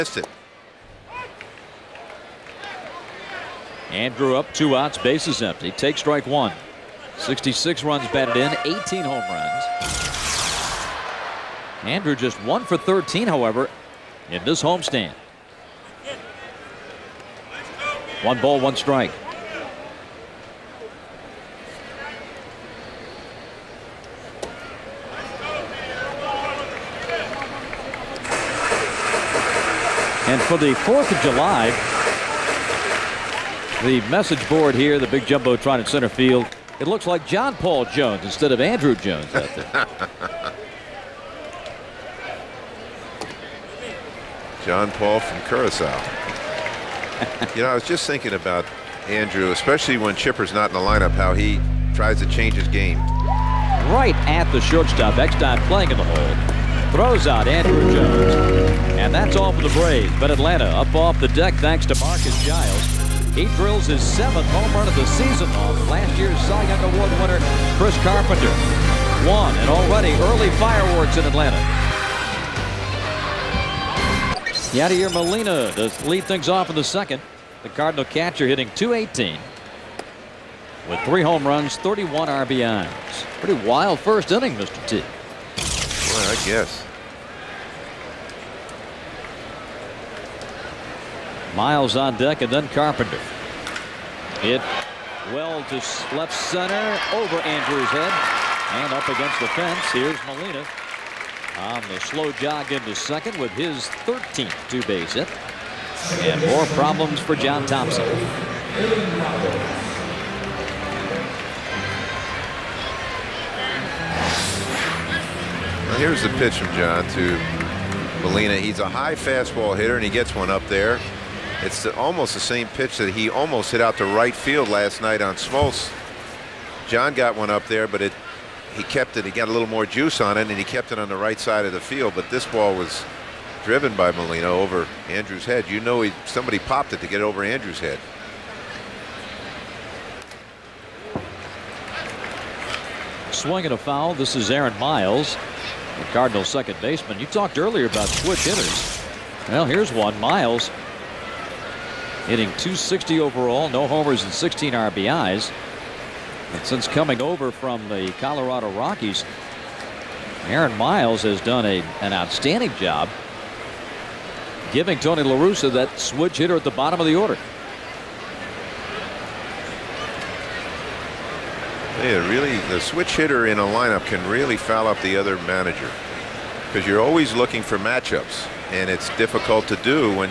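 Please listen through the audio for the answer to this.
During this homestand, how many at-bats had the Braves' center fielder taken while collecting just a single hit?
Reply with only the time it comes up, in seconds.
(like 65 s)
12 s.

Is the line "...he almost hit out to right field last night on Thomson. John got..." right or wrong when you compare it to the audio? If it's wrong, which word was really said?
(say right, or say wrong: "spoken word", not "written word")
wrong: "Smoltz", not "Thomson".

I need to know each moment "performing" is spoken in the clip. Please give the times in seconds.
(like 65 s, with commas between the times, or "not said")
not said.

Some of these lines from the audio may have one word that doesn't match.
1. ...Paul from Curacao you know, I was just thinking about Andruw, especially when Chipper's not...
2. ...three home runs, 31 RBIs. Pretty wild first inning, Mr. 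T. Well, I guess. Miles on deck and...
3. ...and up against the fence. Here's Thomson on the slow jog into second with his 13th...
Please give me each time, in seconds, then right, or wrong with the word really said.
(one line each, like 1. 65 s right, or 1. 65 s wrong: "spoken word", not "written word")
1. 44 s right
2. 81 s right
3. 98 s wrong: "Molina", not "Thomson".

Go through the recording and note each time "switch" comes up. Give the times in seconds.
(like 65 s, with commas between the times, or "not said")
148 s, 165 s, 172 s.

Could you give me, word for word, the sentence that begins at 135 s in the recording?
You know, he, somebody popped it to get over Andruw's head.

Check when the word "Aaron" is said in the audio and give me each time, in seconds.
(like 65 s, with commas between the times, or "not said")
144 s, 160 s.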